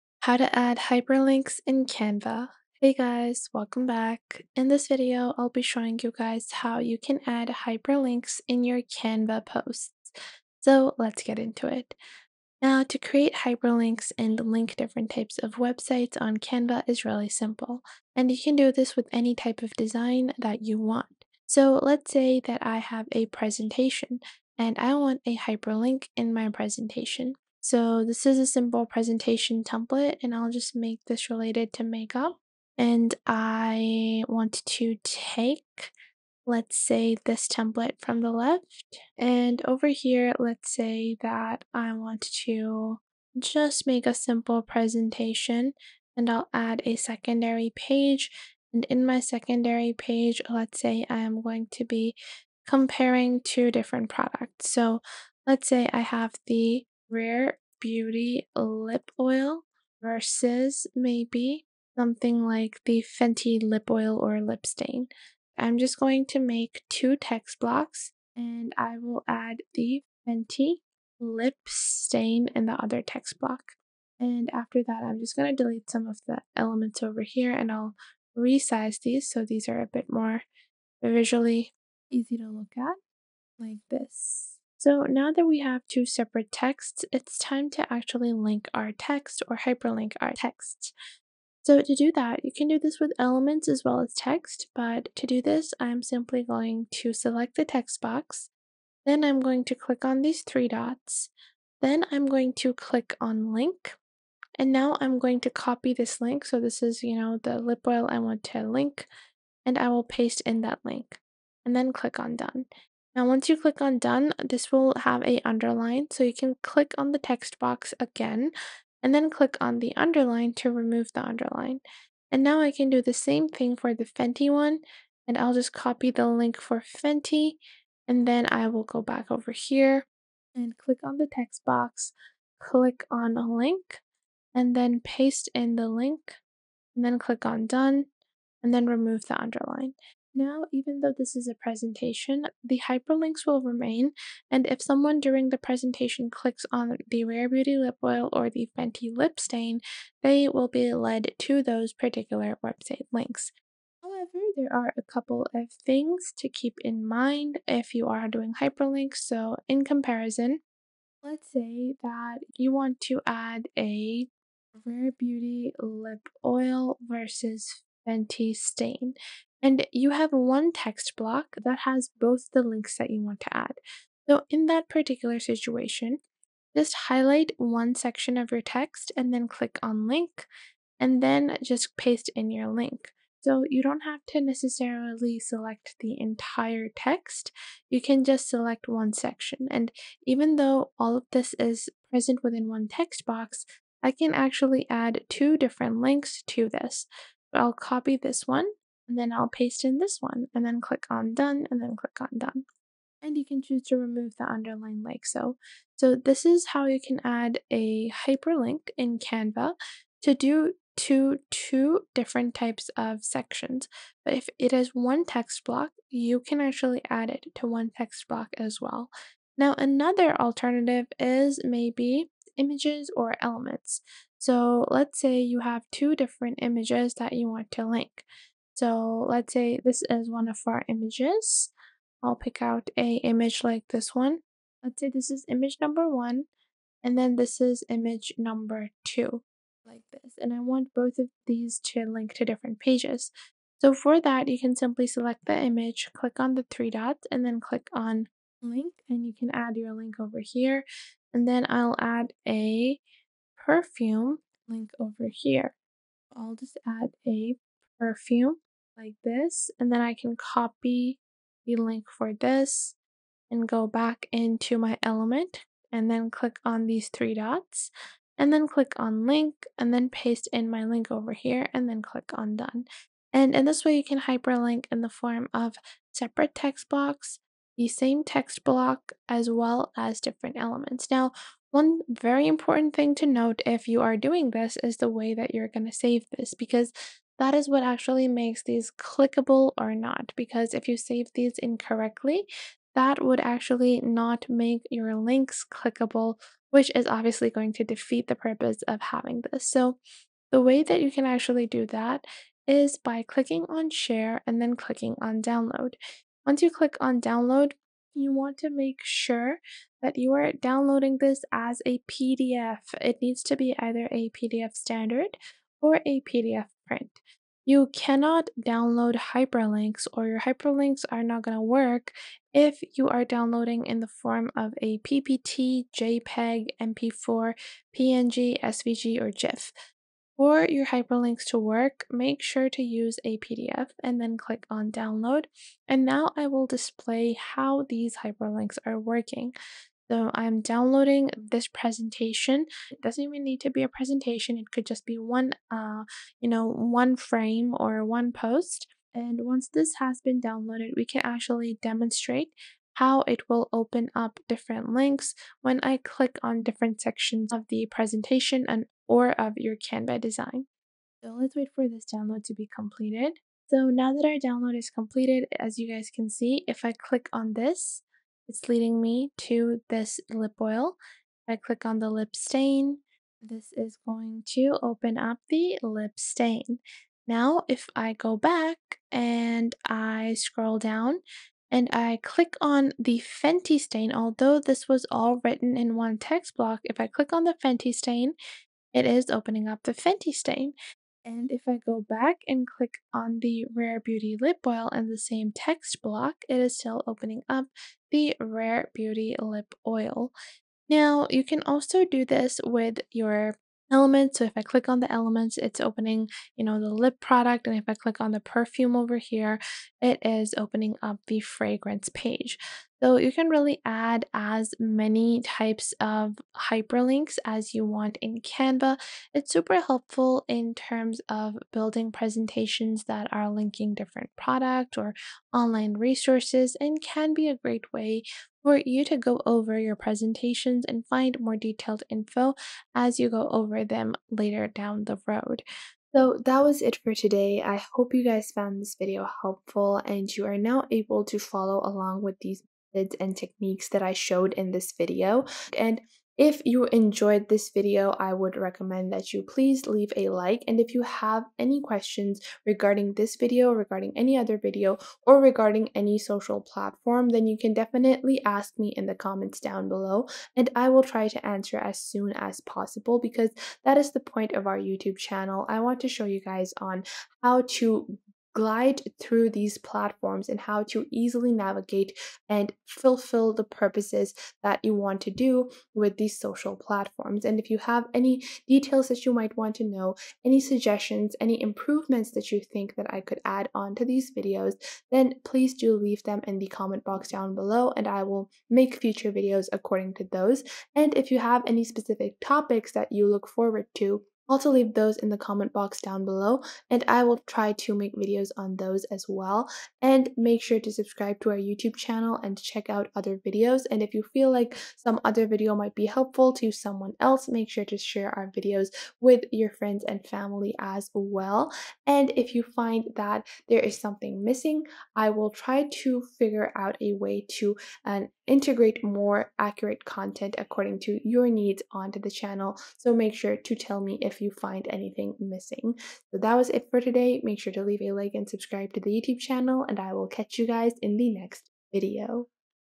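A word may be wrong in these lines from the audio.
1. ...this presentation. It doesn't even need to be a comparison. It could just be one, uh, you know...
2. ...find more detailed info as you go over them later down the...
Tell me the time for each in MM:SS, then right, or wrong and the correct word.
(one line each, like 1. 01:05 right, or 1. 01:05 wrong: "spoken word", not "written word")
1. 05:41 wrong: "presentation", not "comparison"
2. 07:11 right.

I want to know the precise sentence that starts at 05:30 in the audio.
For your hyperlinks to work, make sure to use a PDF and then click on download.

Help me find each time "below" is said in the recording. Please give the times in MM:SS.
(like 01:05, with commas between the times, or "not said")
07:39, 08:07, 08:16.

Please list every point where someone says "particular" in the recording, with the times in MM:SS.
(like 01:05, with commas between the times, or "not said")
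02:31, 02:54.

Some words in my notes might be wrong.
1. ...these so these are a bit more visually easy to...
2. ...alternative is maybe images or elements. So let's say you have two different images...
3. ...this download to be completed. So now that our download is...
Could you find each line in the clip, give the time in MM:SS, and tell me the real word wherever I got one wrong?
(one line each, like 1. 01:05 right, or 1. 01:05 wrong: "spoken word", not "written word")
1. 01:19 right
2. 03:40 right
3. 06:01 right.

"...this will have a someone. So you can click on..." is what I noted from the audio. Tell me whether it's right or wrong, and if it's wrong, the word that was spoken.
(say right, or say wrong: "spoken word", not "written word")
wrong: "underline", not "someone".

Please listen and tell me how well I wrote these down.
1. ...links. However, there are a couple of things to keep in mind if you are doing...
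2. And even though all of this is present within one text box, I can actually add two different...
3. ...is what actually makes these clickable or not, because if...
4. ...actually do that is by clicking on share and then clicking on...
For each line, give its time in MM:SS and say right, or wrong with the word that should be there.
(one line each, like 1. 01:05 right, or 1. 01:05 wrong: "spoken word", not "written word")
1. 02:33 right
2. 03:09 right
3. 04:47 right
4. 05:01 right.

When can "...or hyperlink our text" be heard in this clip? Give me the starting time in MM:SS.
01:29.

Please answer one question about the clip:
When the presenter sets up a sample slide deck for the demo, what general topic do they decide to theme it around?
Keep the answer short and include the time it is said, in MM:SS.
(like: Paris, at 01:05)
Makeup, at 00:31.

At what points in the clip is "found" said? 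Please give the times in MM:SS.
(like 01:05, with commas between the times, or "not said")
07:18.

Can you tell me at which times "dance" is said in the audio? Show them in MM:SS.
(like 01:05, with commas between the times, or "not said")
not said.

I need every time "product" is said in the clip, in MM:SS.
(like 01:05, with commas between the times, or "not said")
00:54, 06:47, 07:04.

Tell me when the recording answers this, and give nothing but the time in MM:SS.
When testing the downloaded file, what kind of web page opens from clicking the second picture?
06:51.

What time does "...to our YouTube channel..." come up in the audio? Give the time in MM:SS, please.
08:21.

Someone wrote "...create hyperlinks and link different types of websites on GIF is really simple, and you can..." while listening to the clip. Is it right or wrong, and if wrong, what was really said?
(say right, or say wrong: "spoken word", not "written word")
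wrong: "Canva", not "GIF".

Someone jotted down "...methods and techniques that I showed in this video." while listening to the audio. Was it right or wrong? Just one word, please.
right.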